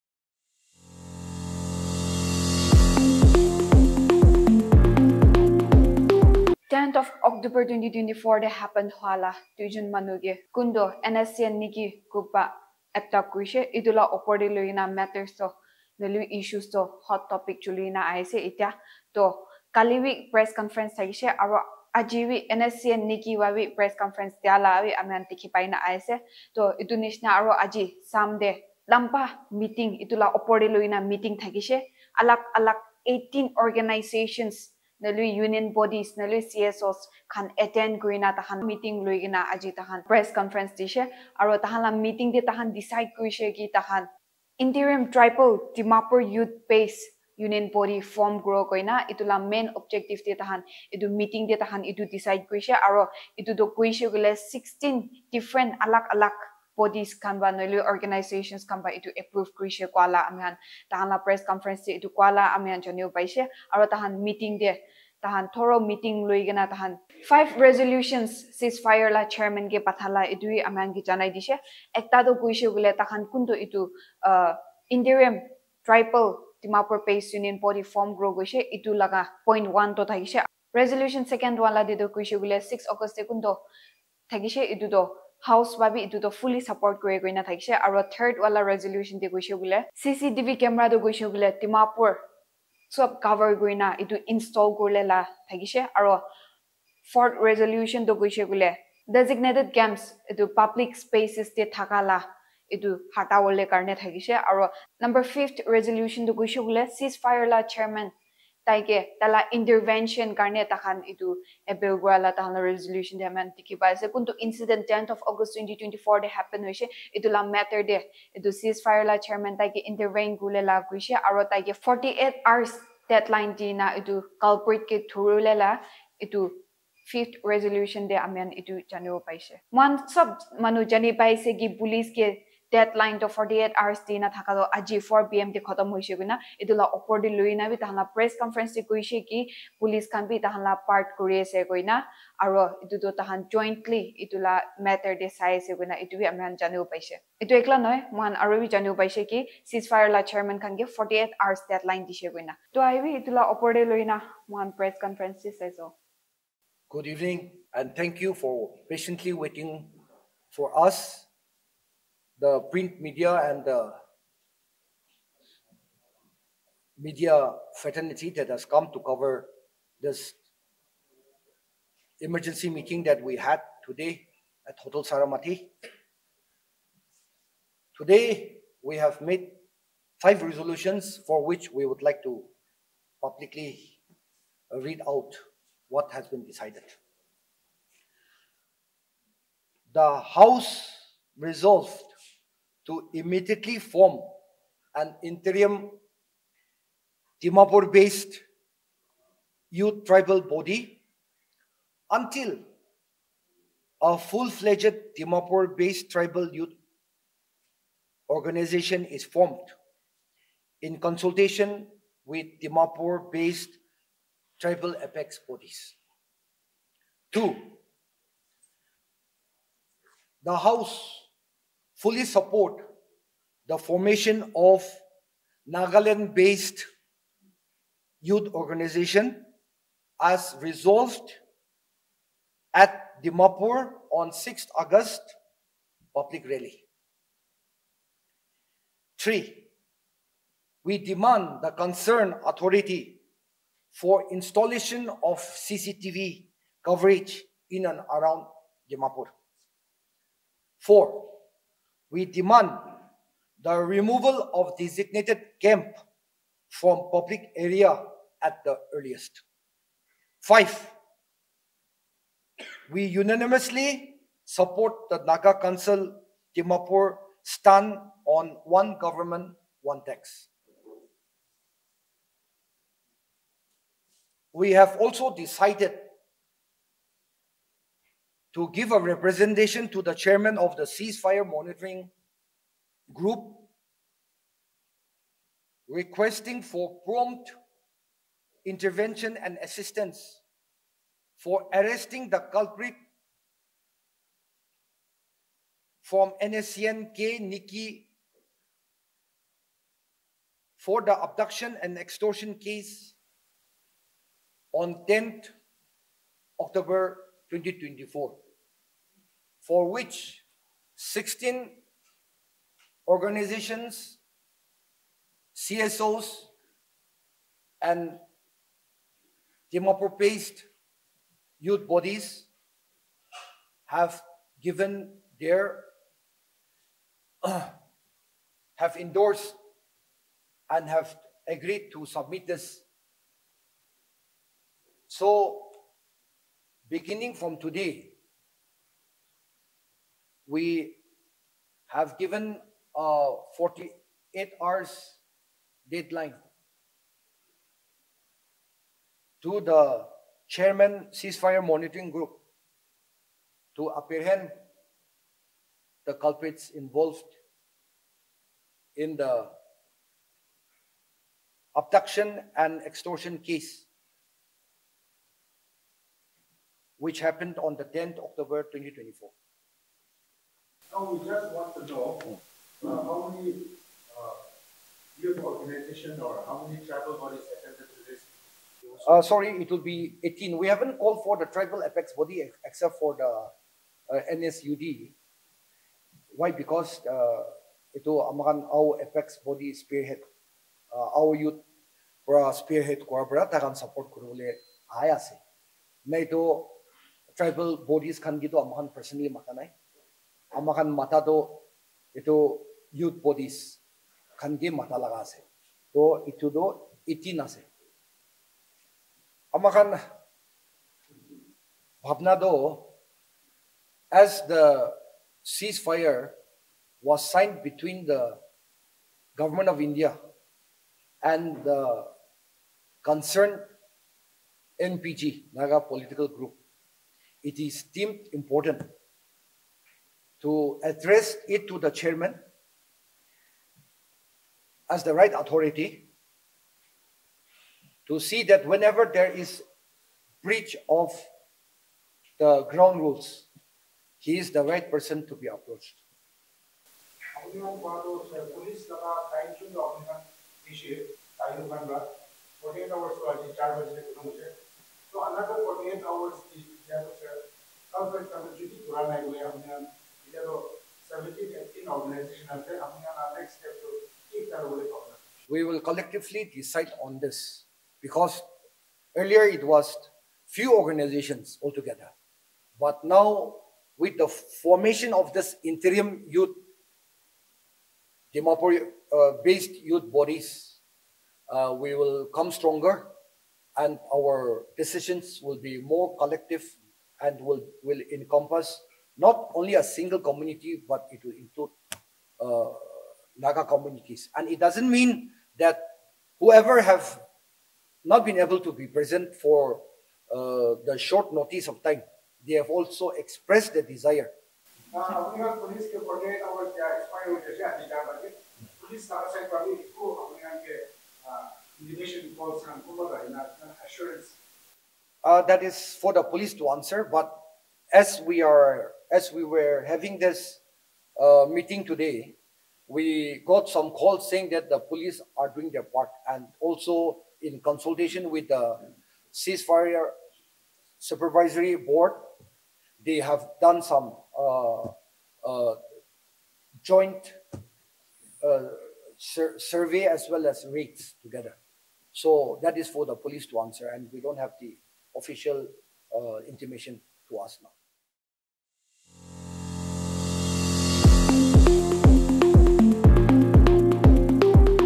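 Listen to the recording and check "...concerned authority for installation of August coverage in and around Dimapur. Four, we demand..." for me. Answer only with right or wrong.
wrong.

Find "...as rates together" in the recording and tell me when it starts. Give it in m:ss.
9:00.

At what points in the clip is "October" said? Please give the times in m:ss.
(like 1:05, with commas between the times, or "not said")
0:07, 5:06, 6:08.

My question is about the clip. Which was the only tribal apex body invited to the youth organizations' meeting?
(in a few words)
NSUD.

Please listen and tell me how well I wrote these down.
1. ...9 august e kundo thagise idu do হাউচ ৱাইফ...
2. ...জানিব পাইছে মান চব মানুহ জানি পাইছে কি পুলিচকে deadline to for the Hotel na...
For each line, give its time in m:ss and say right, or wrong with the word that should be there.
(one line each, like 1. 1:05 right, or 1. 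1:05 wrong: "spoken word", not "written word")
1. 1:22 wrong: "6", not "9"
2. 2:08 wrong: "RST", not "Hotel".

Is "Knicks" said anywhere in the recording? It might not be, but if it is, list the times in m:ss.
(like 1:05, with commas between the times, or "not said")
not said.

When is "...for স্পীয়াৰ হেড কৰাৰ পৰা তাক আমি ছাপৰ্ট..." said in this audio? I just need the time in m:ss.
6:32.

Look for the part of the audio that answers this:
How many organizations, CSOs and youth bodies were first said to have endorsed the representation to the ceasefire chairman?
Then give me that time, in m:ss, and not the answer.
5:10.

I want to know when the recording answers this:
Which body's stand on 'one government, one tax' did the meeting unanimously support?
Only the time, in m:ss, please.
4:25.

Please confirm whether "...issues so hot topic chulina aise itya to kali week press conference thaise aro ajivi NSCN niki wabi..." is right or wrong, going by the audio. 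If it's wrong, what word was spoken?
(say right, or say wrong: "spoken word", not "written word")
right.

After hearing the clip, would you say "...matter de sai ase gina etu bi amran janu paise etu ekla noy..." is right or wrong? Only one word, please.
right.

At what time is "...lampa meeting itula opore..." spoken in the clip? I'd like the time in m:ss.
0:28.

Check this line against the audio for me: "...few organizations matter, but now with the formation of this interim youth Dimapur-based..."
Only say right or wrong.
wrong.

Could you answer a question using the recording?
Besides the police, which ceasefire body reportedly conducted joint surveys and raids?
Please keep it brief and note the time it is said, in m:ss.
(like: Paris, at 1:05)
ceasefire supervisory board, at 8:49.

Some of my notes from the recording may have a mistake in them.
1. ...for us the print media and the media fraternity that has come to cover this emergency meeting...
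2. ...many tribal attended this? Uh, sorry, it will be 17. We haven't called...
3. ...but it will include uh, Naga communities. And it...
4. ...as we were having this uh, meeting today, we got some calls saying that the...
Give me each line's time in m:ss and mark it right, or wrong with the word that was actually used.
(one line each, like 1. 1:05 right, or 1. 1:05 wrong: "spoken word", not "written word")
1. 2:40 right
2. 6:16 wrong: "18", not "17"
3. 8:10 right
4. 8:39 right.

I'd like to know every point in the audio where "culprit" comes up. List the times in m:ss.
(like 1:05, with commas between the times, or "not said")
4:52, 5:56.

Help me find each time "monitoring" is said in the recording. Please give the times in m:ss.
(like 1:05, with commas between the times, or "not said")
4:41, 5:51.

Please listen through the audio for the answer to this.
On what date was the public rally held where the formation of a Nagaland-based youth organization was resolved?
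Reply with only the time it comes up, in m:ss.
3:54.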